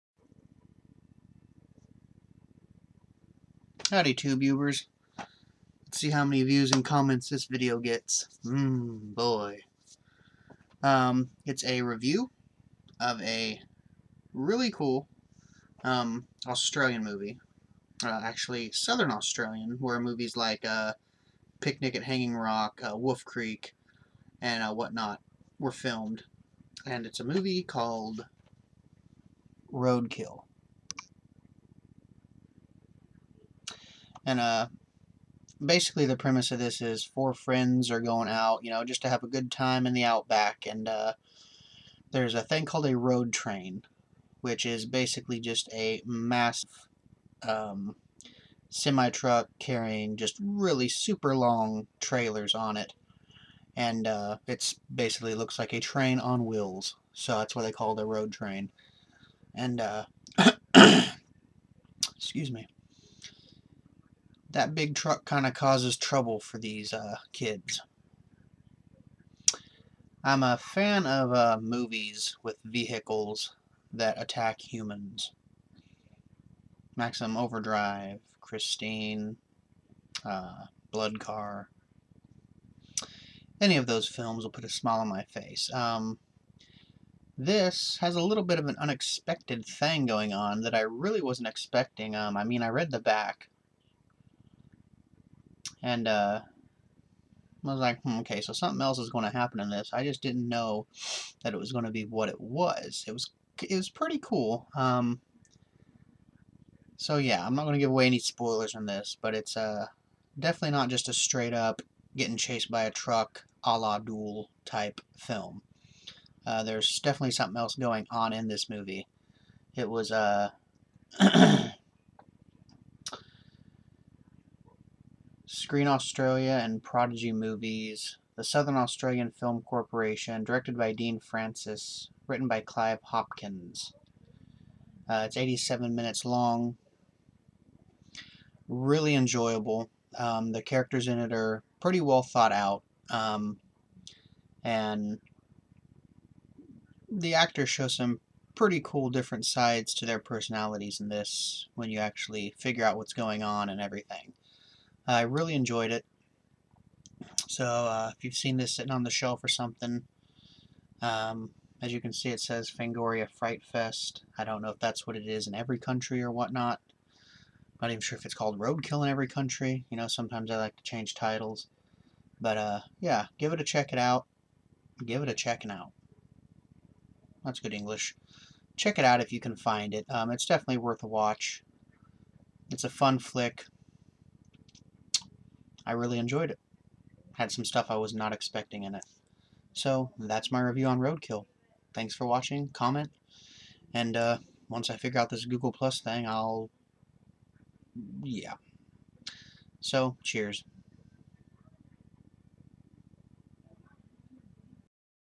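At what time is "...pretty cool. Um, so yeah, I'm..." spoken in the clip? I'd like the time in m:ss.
1:43.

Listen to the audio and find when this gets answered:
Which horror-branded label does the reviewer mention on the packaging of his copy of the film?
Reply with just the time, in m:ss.
2:42.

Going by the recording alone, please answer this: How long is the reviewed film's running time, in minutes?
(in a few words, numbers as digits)
87.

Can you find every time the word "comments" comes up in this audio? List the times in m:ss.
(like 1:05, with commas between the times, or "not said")
0:06, 3:12.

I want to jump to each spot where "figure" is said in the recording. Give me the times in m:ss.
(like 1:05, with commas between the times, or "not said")
2:32, 3:14.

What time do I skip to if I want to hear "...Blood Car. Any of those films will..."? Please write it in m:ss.
1:20.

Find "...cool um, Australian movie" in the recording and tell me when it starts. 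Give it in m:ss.
0:14.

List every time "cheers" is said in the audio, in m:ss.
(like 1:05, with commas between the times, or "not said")
3:20.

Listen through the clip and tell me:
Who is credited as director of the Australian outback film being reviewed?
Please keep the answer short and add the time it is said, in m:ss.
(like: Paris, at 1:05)
Dean Francis, at 2:10.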